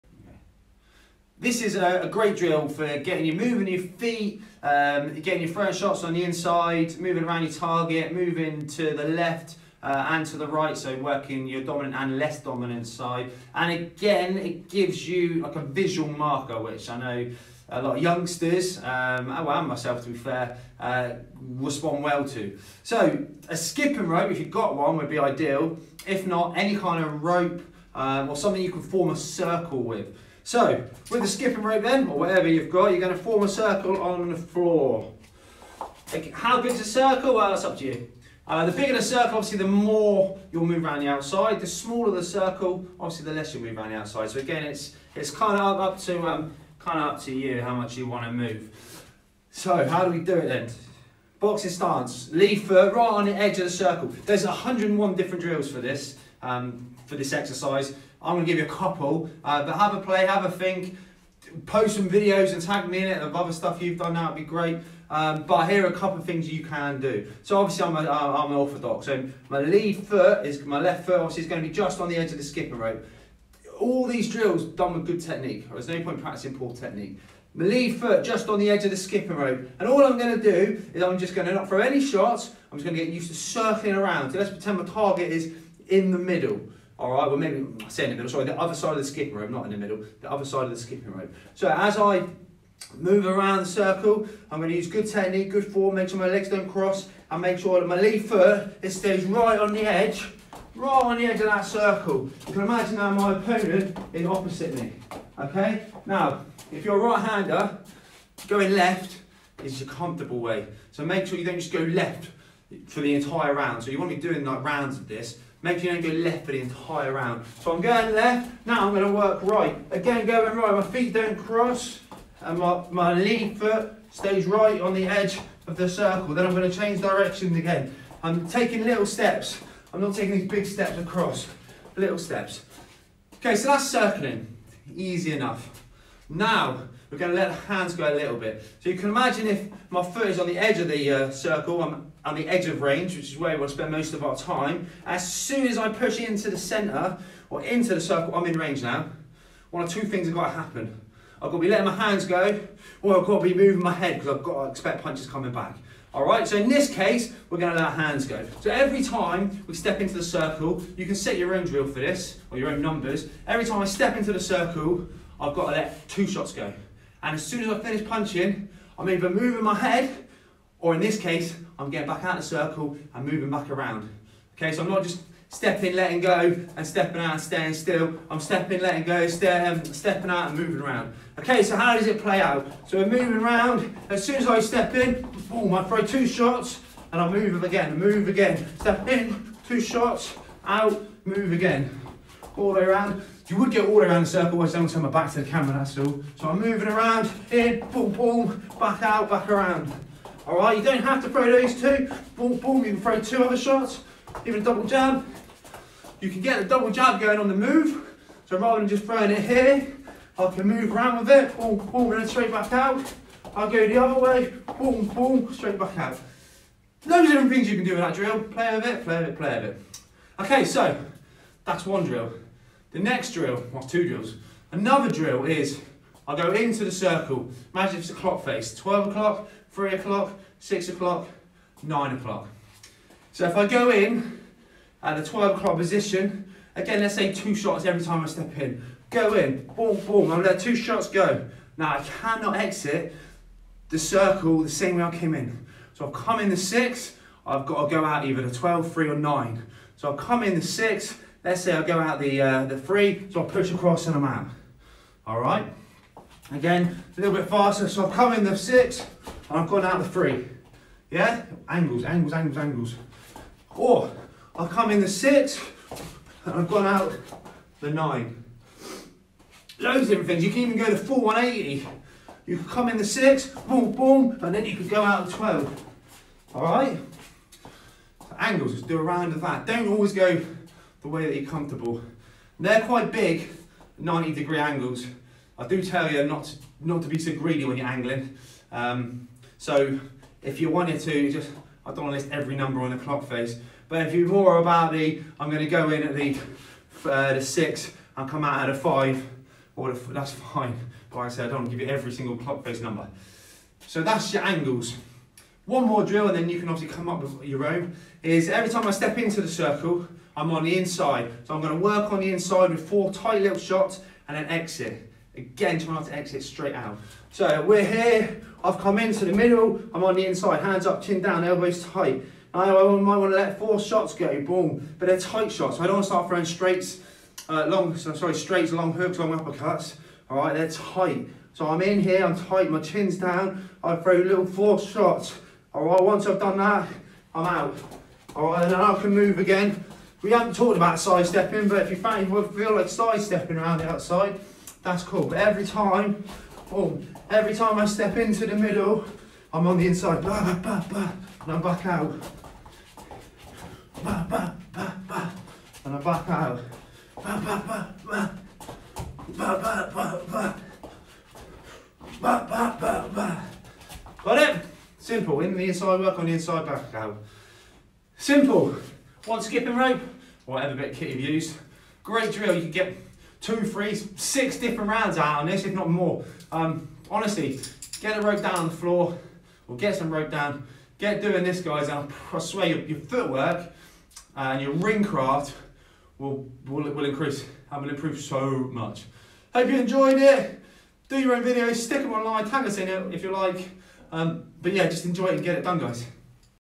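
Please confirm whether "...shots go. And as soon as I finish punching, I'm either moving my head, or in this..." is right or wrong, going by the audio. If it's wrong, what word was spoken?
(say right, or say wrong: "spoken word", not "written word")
right.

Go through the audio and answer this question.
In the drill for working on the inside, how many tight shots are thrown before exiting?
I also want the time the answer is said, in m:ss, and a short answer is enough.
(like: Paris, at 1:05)
4, at 5:12.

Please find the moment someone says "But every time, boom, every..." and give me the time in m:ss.
5:45.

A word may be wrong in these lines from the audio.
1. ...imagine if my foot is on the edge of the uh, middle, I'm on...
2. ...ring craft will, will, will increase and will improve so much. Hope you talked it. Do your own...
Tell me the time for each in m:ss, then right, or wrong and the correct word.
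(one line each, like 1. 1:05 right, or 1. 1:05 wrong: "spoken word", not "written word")
1. 2:19 wrong: "circle", not "middle"
2. 6:24 wrong: "enjoyed", not "talked".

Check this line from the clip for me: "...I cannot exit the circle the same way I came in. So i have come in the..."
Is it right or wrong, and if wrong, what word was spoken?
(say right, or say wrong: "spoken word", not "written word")
right.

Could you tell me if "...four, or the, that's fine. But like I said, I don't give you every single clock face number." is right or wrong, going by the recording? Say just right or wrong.
wrong.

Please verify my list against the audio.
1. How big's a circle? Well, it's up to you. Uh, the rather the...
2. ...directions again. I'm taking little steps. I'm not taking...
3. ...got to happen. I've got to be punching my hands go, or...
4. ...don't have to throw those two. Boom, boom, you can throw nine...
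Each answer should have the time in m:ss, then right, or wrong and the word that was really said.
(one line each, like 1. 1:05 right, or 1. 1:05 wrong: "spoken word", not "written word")
1. 0:36 wrong: "bigger", not "rather"
2. 2:07 right
3. 2:30 wrong: "letting", not "punching"
4. 3:20 wrong: "two", not "nine".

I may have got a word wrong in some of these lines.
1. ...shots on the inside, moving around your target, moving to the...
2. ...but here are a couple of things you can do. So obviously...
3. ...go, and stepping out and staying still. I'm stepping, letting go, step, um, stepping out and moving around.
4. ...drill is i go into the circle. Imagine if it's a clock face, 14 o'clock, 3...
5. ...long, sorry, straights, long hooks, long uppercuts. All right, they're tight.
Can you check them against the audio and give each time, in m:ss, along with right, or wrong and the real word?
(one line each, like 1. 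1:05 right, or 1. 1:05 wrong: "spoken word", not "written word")
1. 0:05 right
2. 1:05 right
3. 2:56 right
4. 3:45 wrong: "12", not "14"
5. 5:27 right.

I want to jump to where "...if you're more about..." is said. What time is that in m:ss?
4:54.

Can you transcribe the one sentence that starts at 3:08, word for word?
Step in, two shots, out, move again all the way around.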